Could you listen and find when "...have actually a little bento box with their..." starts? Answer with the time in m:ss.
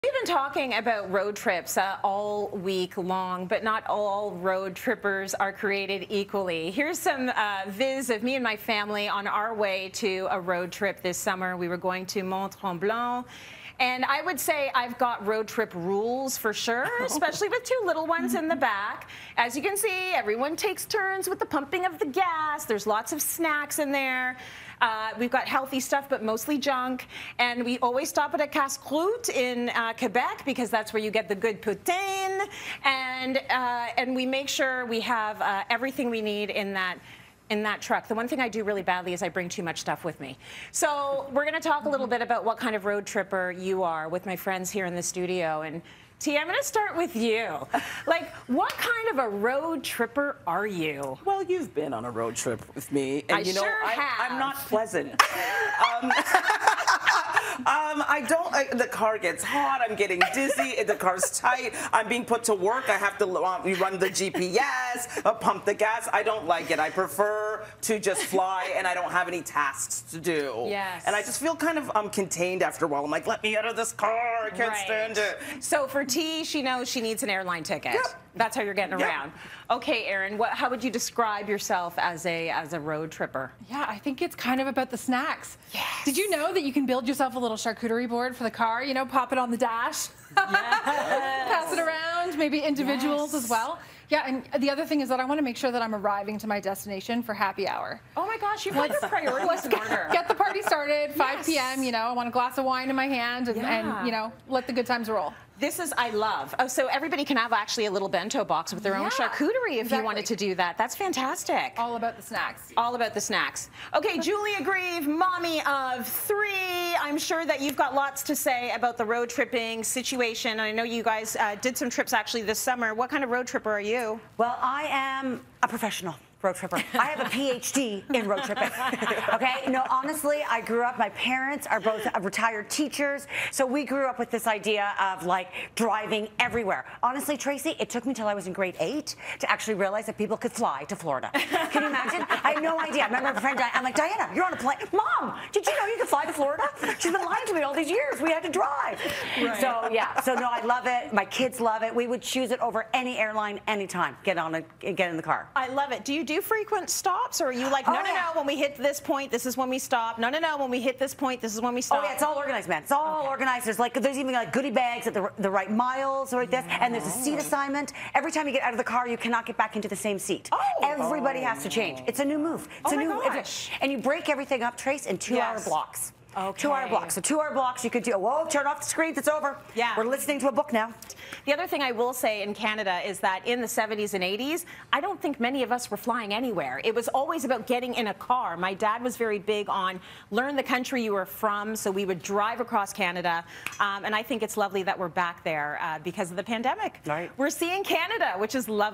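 1:47.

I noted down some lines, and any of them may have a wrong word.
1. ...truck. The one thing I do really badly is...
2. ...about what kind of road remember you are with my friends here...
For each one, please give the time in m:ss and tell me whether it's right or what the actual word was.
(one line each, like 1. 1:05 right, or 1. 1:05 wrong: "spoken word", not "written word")
1. 0:37 right
2. 0:42 wrong: "tripper", not "remember".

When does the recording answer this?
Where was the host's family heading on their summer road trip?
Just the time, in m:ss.
0:12.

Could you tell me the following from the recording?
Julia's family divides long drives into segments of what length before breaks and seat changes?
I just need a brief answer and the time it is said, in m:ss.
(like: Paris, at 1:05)
2 hours, at 2:55.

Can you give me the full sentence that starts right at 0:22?
There's lots of snacks in there.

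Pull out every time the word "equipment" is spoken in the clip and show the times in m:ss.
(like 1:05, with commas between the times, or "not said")
not said.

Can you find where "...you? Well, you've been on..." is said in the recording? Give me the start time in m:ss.
0:50.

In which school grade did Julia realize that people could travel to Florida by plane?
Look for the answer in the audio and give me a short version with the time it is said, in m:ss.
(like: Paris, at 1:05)
Grade 8, at 2:18.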